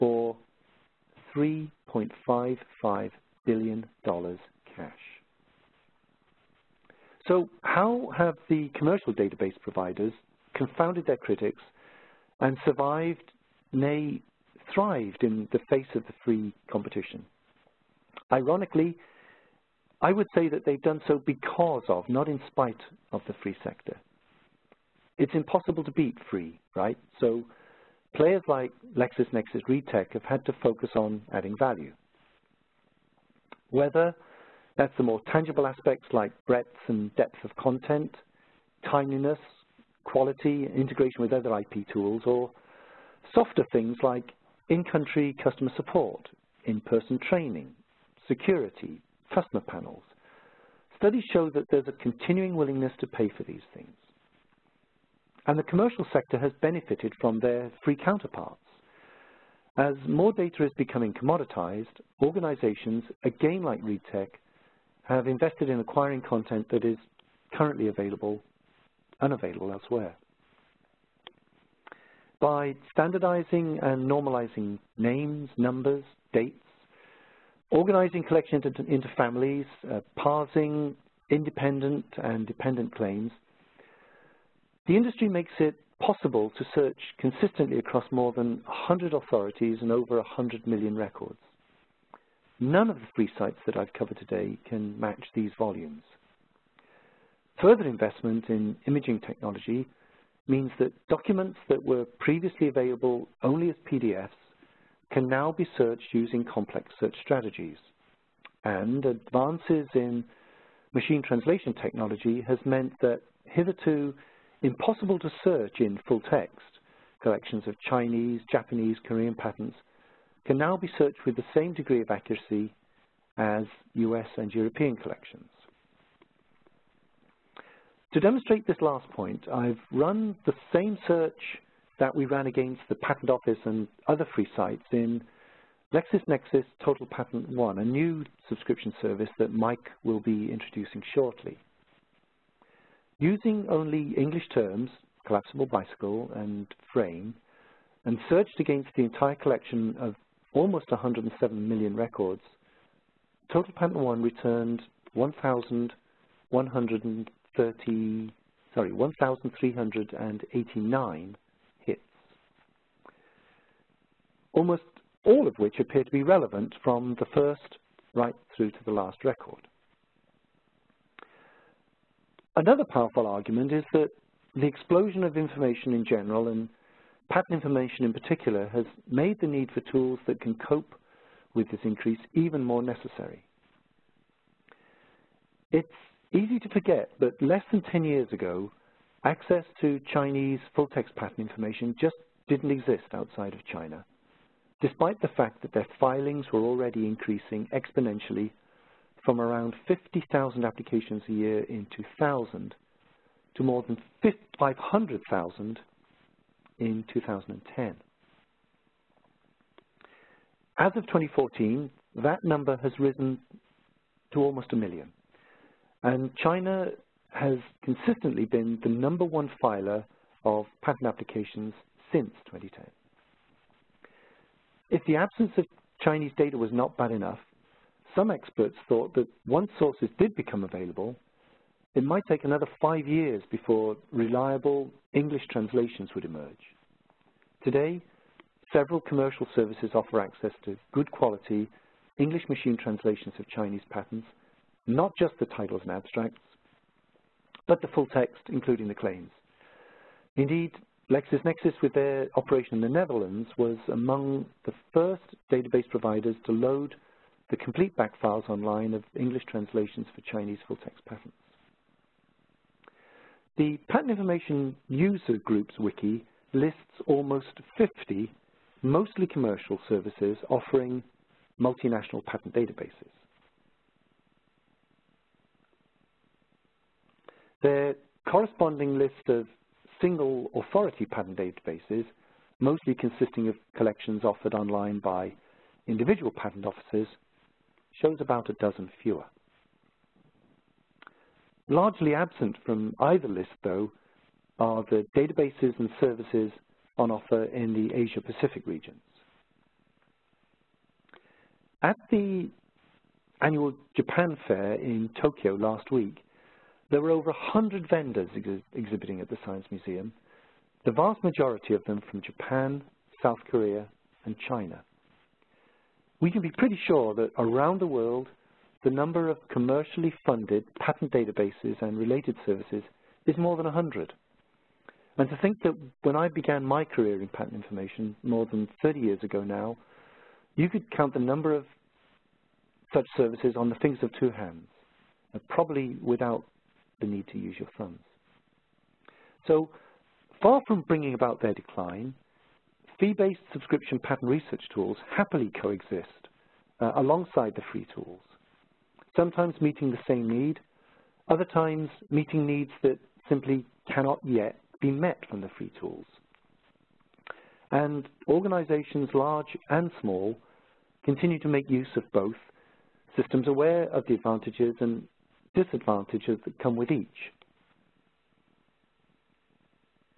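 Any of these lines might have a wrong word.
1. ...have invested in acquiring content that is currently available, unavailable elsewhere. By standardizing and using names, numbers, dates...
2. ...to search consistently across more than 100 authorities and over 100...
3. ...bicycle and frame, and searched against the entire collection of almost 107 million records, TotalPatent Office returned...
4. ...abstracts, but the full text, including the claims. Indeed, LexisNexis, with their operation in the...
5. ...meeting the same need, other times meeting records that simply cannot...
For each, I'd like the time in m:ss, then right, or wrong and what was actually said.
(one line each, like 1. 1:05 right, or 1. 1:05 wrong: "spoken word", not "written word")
1. 1:05 wrong: "normalizing", not "using"
2. 1:26 right
3. 2:25 wrong: "One", not "Office"
4. 4:05 right
5. 5:49 wrong: "needs", not "records".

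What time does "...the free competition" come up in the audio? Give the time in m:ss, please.
0:16.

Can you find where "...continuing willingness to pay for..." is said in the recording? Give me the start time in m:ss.
0:52.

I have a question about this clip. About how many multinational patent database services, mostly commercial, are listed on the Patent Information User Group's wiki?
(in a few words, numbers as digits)
almost 50.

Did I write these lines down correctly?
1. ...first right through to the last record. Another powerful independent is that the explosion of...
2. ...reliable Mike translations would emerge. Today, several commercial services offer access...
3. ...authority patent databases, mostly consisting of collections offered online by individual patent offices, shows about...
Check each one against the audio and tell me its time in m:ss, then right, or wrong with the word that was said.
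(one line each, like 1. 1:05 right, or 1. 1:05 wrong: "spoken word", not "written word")
1. 2:47 wrong: "argument", not "independent"
2. 3:54 wrong: "English", not "Mike"
3. 4:40 right.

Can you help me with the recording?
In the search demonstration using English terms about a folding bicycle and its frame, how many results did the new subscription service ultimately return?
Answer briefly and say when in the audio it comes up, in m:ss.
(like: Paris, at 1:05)
1,389, at 2:38.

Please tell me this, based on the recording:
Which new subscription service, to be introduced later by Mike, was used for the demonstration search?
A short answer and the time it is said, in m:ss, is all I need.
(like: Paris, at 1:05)
LexisNexis TotalPatent One, at 2:15.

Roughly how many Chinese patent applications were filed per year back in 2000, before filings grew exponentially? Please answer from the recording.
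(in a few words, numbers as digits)
50,000.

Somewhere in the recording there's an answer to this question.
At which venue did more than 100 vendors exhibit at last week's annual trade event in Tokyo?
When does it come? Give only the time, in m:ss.
5:09.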